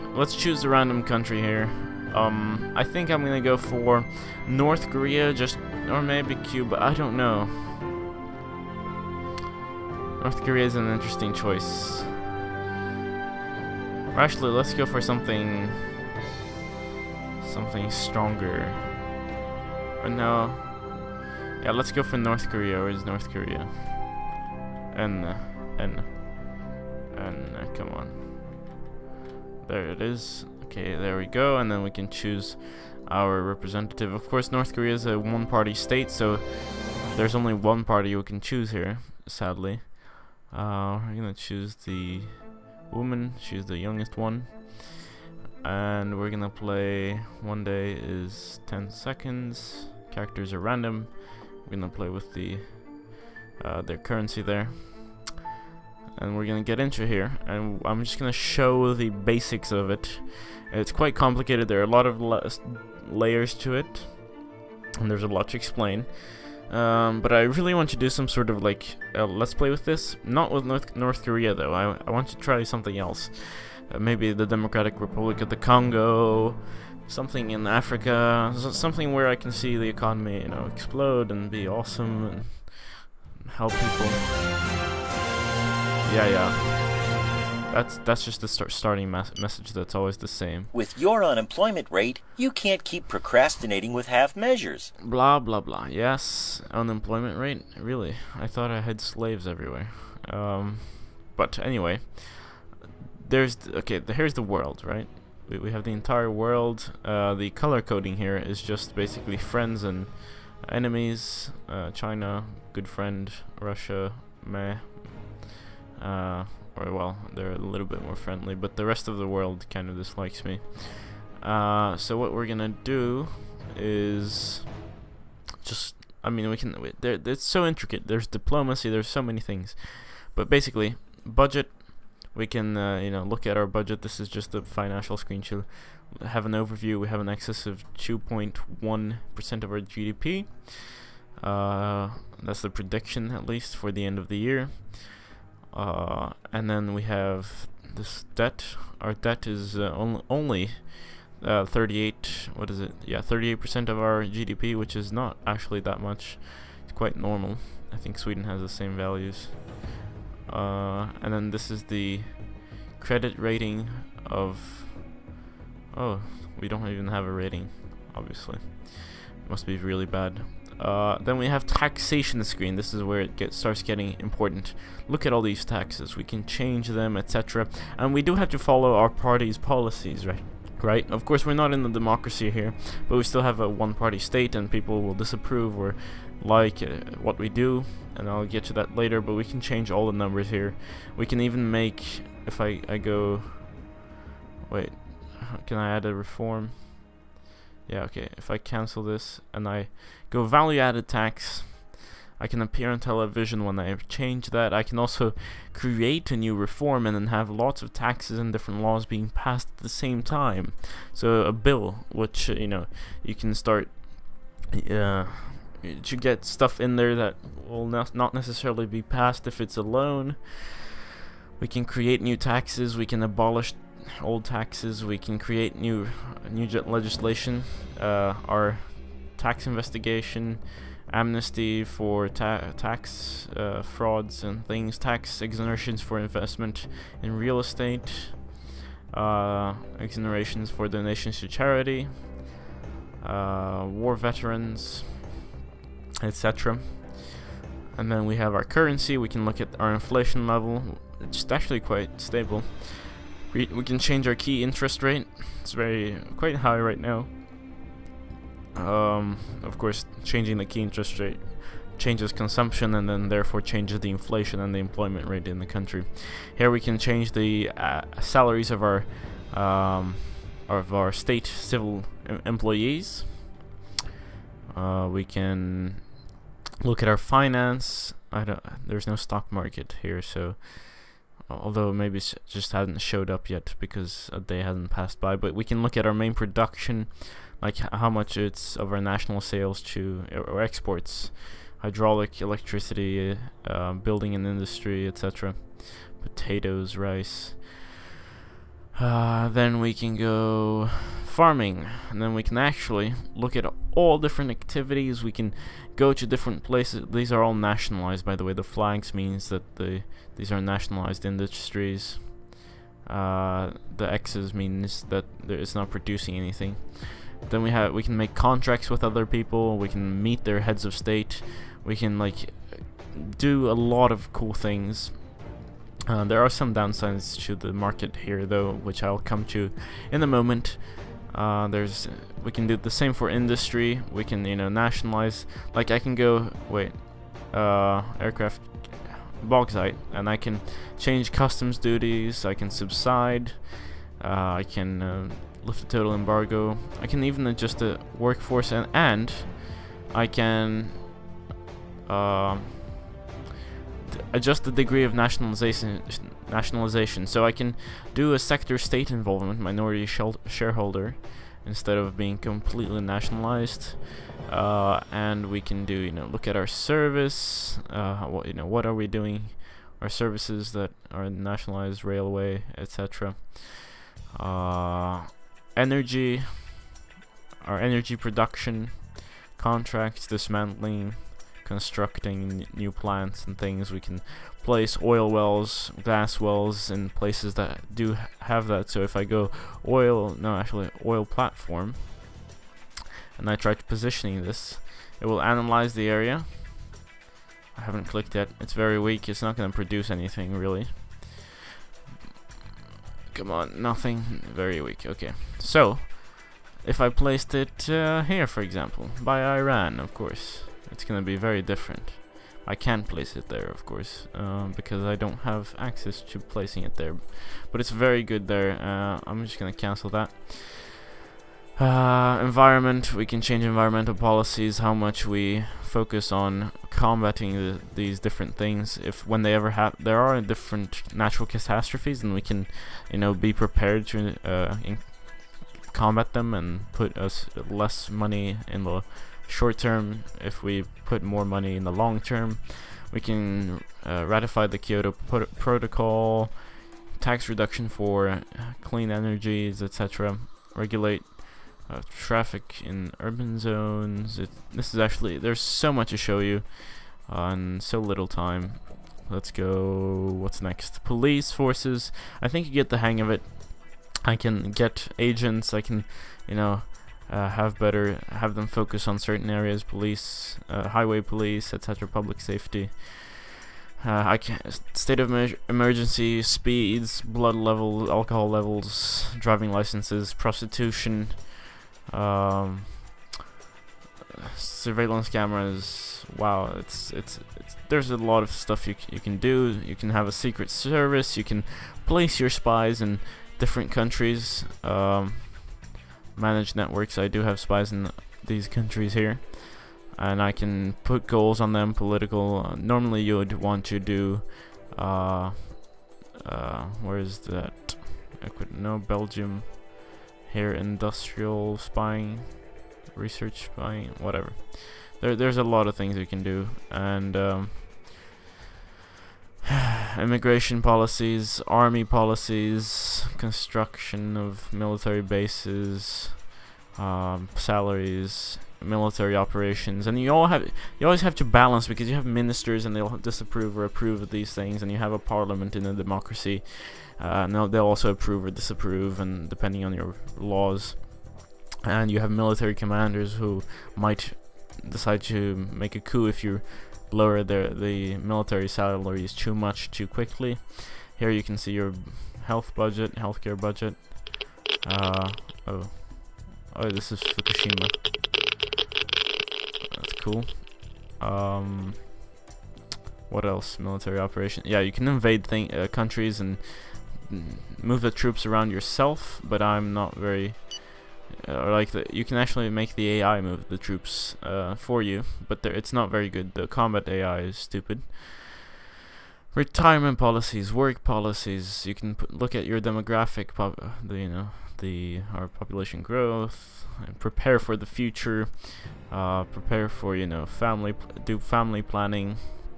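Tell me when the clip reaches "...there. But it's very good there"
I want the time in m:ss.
6:56.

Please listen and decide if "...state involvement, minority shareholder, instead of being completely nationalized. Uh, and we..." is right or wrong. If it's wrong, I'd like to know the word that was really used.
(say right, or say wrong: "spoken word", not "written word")
right.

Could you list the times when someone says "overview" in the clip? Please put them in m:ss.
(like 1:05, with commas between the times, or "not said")
2:16.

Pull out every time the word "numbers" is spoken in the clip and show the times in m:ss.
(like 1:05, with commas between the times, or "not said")
3:10.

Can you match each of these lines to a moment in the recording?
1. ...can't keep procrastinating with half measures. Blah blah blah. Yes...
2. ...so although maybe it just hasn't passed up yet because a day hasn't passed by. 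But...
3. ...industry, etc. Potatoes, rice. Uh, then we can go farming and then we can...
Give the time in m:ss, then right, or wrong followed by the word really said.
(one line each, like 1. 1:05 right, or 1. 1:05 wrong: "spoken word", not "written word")
1. 1:32 right
2. 4:40 wrong: "showed", not "passed"
3. 4:54 right.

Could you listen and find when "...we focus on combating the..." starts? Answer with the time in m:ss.
7:05.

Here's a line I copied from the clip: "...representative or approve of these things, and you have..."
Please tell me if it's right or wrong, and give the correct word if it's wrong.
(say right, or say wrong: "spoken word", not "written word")
wrong: "disapprove", not "representative".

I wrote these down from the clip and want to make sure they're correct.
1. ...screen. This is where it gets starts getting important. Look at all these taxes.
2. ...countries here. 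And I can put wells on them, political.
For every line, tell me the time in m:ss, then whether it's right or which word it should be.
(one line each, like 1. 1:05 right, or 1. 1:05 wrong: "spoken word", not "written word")
1. 2:52 right
2. 8:18 wrong: "goals", not "wells".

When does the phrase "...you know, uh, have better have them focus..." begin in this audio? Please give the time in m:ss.
7:46.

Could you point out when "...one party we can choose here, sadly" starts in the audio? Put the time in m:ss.
0:37.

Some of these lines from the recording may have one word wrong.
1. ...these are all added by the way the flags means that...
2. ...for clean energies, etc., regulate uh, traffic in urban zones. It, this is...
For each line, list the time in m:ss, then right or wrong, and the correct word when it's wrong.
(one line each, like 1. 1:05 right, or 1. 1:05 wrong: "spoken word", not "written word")
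1. 5:07 wrong: "nationalized", not "added"
2. 7:27 right.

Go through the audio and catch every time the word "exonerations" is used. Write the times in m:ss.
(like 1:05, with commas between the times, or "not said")
3:55, 3:59.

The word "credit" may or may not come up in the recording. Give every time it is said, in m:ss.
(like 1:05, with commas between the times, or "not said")
2:42.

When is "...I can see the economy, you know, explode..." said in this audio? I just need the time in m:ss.
1:19.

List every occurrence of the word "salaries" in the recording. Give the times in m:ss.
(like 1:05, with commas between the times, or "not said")
4:28, 8:47, 9:08.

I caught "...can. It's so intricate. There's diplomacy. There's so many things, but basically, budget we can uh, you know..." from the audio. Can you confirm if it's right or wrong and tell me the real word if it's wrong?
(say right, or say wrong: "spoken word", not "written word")
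right.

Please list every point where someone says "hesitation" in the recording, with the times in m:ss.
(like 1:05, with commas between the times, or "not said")
not said.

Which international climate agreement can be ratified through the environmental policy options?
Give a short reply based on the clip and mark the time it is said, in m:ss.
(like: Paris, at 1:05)
Kyoto Protocol, at 7:24.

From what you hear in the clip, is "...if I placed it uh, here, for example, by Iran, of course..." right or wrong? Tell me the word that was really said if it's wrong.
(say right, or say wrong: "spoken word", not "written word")
right.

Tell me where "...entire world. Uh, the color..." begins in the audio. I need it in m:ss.
1:45.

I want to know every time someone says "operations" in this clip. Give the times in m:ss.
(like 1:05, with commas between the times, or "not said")
8:49, 9:24.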